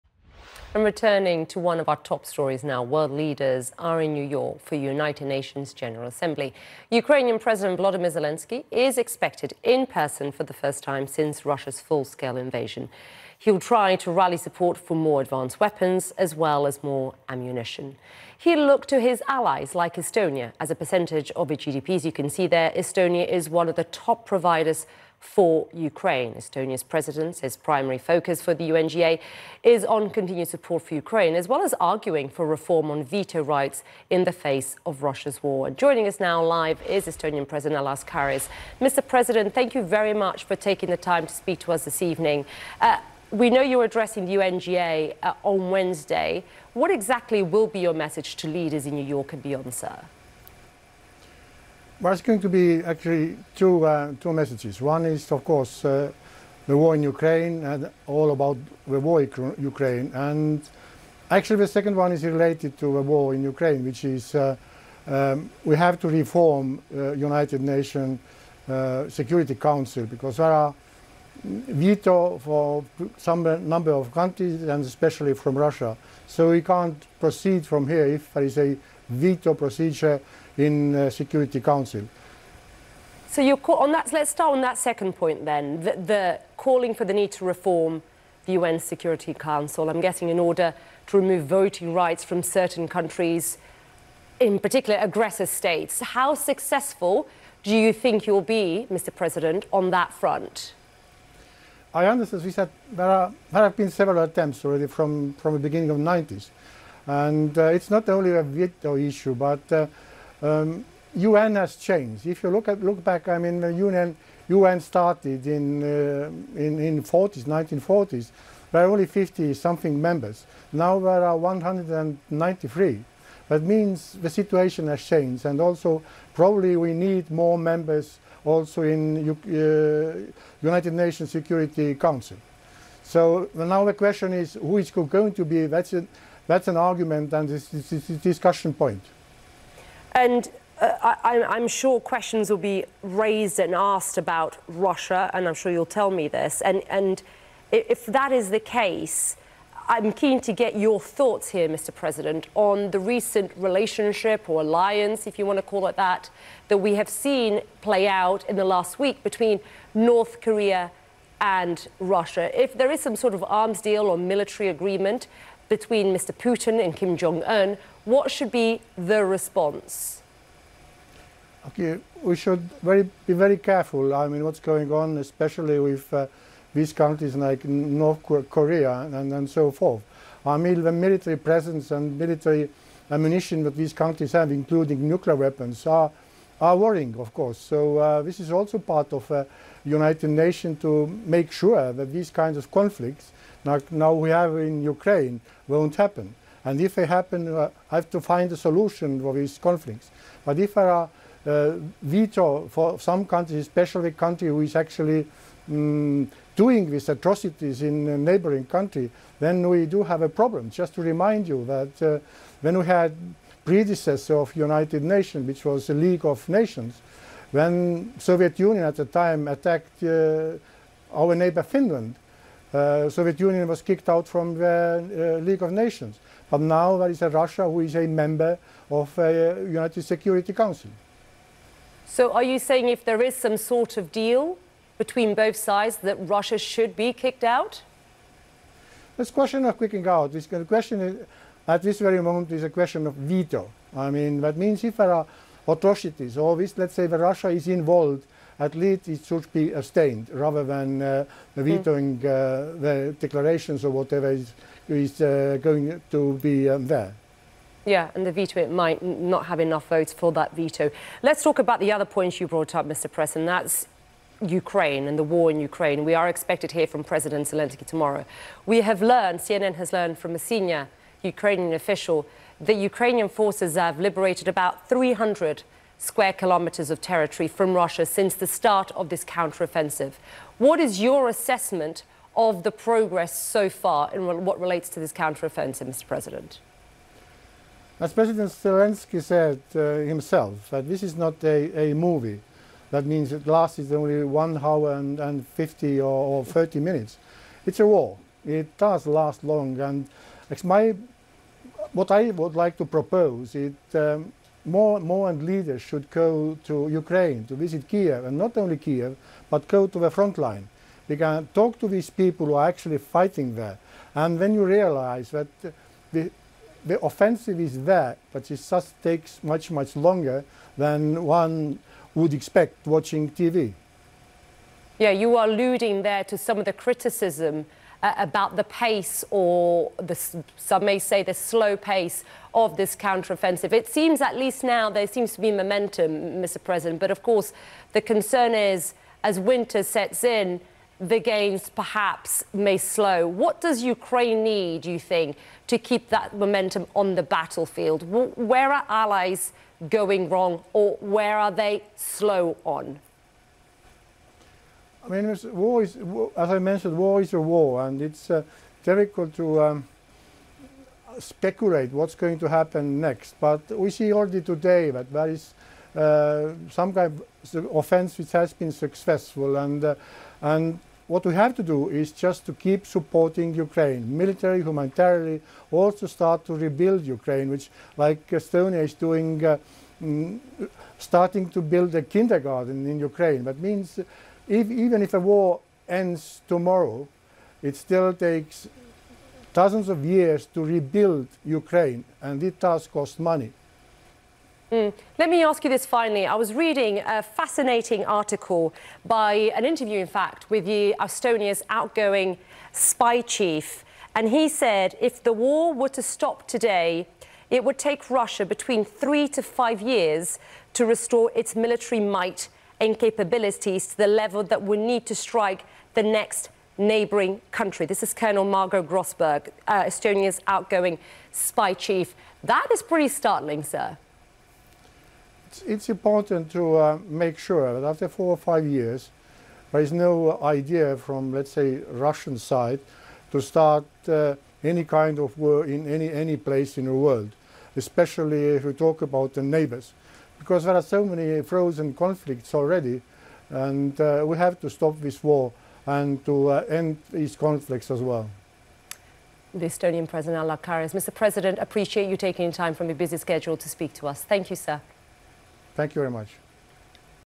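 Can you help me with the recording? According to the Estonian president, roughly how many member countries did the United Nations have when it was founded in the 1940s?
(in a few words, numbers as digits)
50 something.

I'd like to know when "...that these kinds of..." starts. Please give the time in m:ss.
3:11.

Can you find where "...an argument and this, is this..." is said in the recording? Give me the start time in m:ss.
2:16.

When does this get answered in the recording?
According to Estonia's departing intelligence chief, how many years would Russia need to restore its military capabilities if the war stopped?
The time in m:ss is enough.
6:48.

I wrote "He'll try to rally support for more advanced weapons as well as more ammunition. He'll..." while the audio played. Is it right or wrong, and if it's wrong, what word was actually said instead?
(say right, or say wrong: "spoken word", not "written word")
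right.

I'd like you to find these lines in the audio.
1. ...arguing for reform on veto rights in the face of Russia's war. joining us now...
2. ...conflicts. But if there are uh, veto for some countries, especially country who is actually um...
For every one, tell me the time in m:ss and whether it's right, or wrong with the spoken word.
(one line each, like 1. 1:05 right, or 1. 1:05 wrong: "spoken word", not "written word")
1. 0:31 right
2. 3:19 right.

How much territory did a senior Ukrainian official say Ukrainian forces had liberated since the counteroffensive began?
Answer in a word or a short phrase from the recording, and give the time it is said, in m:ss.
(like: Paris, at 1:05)
300 square kilometers, at 4:34.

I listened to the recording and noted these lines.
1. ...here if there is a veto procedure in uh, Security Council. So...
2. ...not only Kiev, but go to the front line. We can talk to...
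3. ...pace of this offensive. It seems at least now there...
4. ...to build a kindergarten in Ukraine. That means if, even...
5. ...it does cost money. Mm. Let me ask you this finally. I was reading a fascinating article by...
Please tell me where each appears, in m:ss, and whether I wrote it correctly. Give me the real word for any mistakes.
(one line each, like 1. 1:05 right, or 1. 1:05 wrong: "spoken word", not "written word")
1. 1:17 right
2. 5:08 right
3. 5:31 wrong: "counteroffensive", not "offensive"
4. 6:21 right
5. 6:32 right.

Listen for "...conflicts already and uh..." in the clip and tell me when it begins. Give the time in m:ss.
7:21.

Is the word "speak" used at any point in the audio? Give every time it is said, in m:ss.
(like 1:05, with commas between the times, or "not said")
0:41, 7:33.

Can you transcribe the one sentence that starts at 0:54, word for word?
One is, of course, uh, the war in Ukraine and all about the war in Ukraine.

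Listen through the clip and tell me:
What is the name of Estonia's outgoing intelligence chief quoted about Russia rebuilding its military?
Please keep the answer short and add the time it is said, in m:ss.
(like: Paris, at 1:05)
Margo Grosberg, at 6:58.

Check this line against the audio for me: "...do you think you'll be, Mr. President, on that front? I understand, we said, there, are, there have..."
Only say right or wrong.
right.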